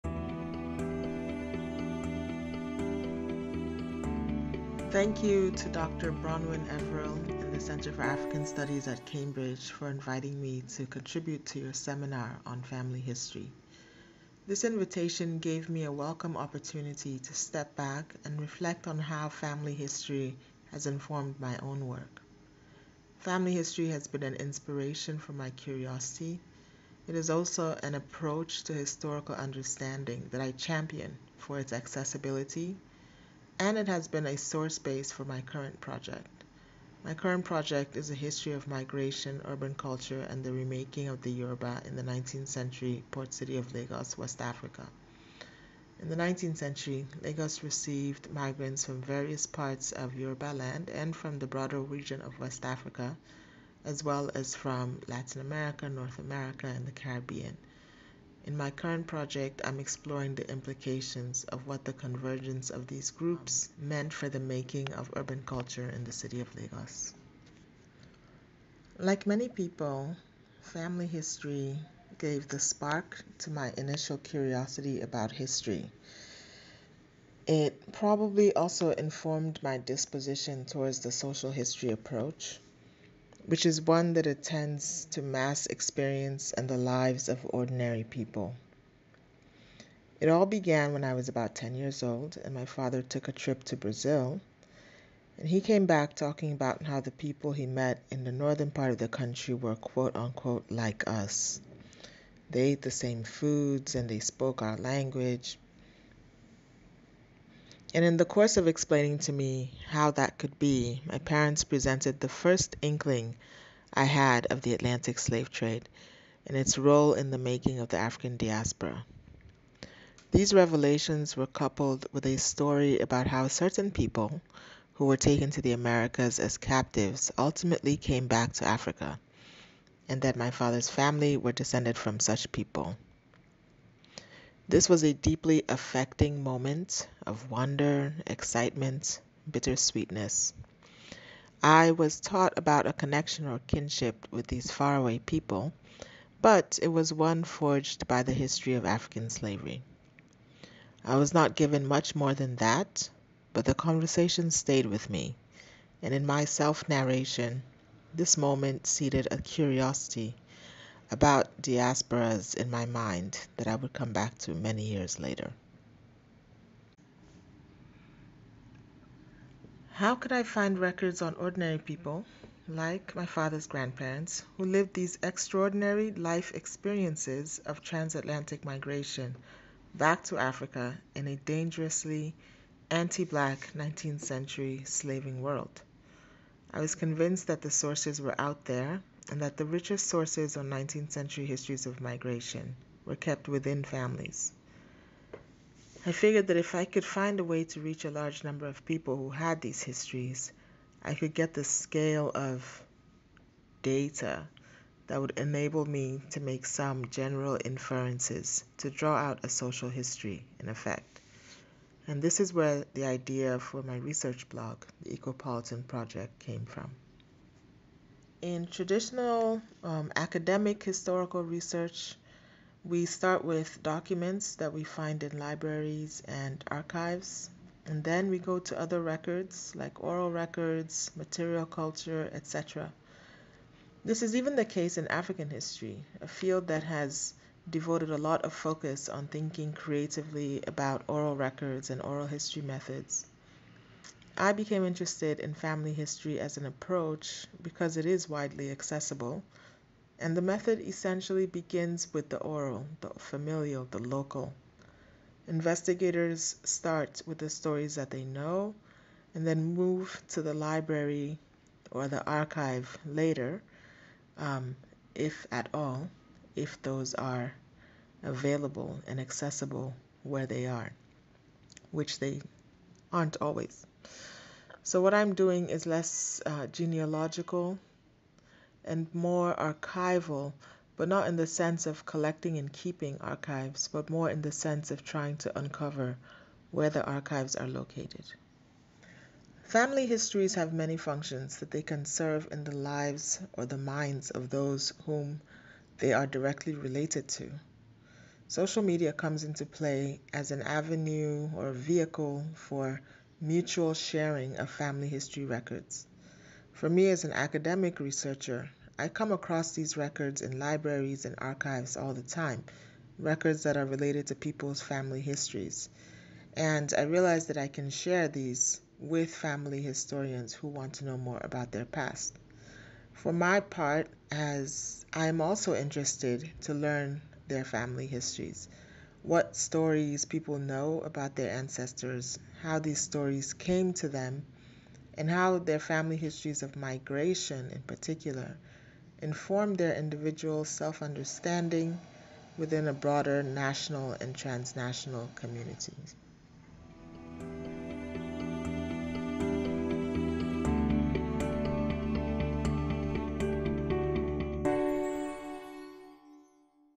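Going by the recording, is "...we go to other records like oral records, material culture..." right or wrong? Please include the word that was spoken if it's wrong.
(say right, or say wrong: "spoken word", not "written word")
right.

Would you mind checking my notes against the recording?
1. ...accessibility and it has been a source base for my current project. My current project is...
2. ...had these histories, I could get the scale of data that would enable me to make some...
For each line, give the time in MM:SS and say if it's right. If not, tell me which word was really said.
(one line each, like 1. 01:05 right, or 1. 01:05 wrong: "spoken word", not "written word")
1. 00:31 right
2. 03:19 right.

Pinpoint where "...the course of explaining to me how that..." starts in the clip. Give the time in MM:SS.
01:48.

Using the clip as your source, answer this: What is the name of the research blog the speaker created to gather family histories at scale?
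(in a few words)
Ekopolitan Project.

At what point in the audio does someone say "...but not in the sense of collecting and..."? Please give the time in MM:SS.
04:40.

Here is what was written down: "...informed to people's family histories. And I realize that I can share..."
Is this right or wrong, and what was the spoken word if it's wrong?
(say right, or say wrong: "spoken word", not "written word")
wrong: "related", not "informed".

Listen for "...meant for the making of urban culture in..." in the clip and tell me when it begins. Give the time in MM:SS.
01:03.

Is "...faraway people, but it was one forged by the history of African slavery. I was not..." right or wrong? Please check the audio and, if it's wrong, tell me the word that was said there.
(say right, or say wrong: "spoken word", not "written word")
right.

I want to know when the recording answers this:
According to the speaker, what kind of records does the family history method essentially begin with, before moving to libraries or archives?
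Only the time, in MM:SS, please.
04:12.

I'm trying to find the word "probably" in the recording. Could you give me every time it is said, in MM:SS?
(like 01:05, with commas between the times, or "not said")
01:17.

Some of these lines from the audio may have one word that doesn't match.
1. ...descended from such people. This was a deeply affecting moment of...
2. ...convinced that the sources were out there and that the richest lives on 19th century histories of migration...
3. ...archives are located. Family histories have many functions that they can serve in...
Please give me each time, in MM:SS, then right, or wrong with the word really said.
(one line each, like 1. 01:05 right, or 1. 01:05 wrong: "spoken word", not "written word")
1. 02:11 right
2. 03:06 wrong: "sources", not "lives"
3. 04:47 right.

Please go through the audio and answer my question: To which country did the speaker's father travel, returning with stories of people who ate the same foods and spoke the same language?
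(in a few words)
Brazil.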